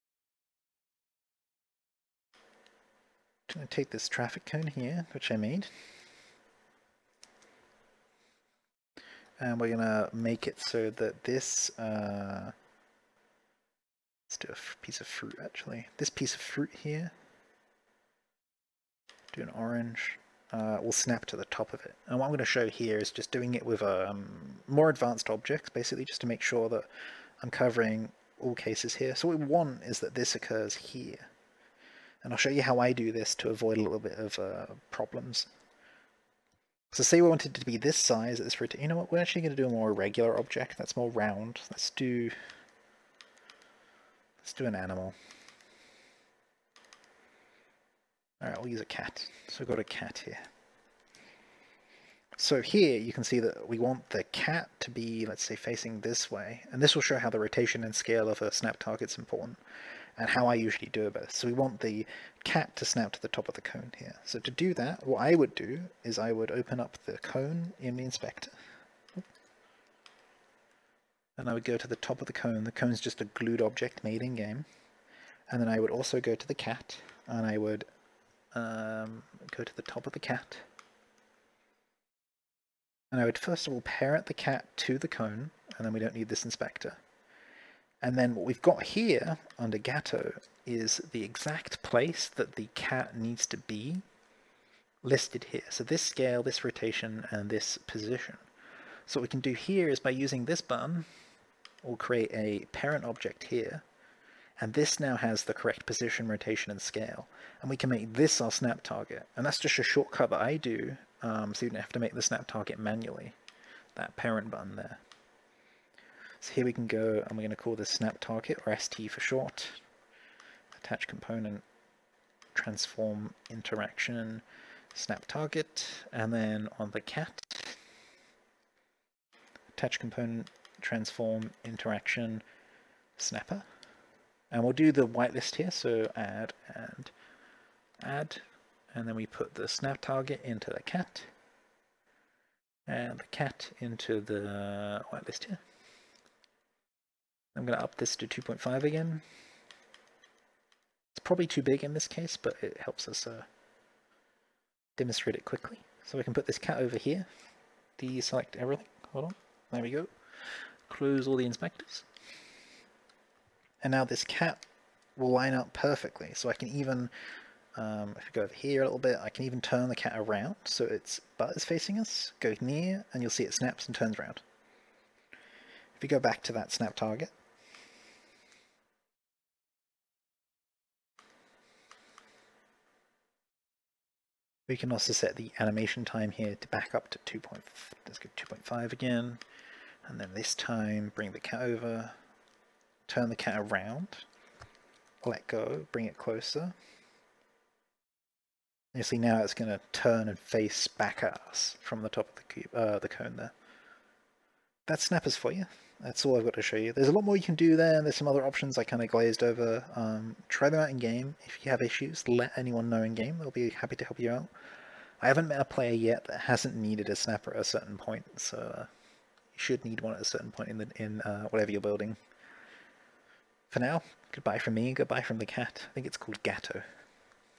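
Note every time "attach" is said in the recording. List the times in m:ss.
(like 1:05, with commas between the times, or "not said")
2:00, 2:09.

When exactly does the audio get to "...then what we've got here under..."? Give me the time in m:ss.
1:28.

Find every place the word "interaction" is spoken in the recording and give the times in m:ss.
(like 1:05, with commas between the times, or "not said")
2:03, 2:11.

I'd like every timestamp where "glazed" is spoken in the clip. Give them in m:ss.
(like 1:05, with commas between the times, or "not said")
3:29.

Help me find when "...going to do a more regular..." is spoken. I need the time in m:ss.
0:39.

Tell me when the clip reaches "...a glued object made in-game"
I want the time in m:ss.
1:13.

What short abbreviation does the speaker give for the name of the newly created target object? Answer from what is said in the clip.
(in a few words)
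ST.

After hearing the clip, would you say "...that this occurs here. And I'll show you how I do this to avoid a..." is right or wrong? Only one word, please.
right.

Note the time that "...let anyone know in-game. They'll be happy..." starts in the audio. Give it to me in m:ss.
3:32.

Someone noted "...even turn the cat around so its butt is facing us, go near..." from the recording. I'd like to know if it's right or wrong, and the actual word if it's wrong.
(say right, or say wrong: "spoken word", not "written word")
right.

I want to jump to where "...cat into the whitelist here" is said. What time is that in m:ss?
2:23.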